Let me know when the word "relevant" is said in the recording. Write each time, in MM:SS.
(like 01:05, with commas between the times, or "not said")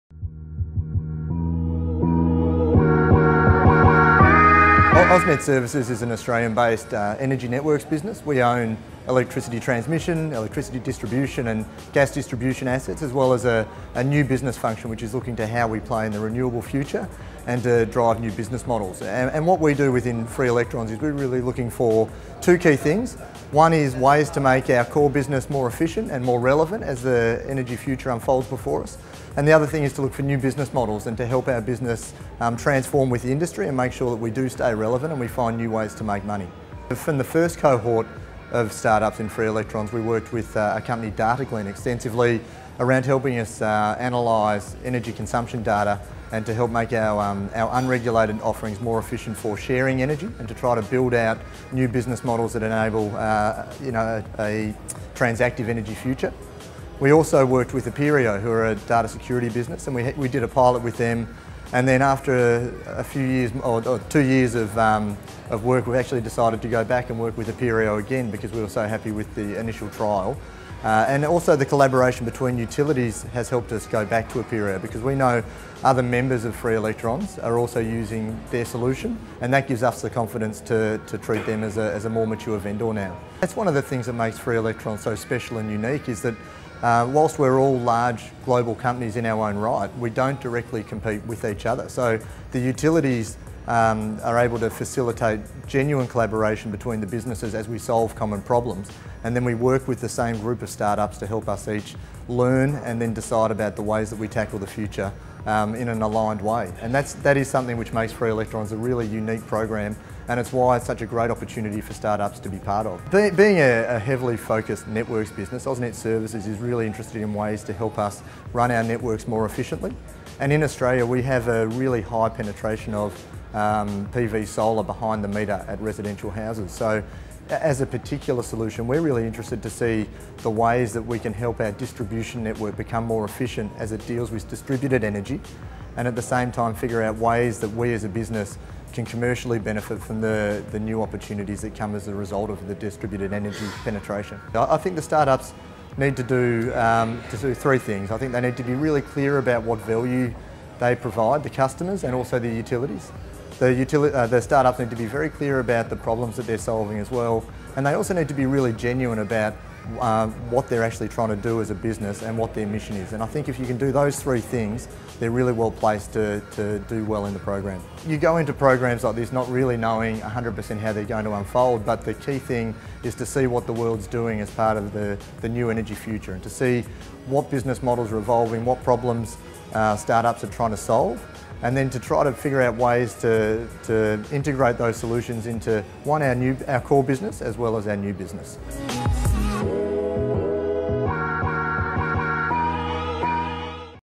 00:26, 00:34.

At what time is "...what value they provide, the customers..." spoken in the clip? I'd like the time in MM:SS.
02:29.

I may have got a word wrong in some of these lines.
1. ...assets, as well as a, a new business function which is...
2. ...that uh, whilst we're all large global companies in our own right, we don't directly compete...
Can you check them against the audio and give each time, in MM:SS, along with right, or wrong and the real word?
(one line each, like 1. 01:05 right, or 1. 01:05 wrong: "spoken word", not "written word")
1. 00:12 right
2. 01:26 right.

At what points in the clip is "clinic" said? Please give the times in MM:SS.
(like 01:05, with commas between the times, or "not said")
not said.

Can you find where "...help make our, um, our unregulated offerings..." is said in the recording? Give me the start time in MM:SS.
00:46.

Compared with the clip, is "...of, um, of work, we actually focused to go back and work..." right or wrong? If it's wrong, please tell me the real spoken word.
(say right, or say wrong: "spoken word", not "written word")
wrong: "decided", not "focused".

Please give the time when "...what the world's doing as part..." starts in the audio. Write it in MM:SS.
02:53.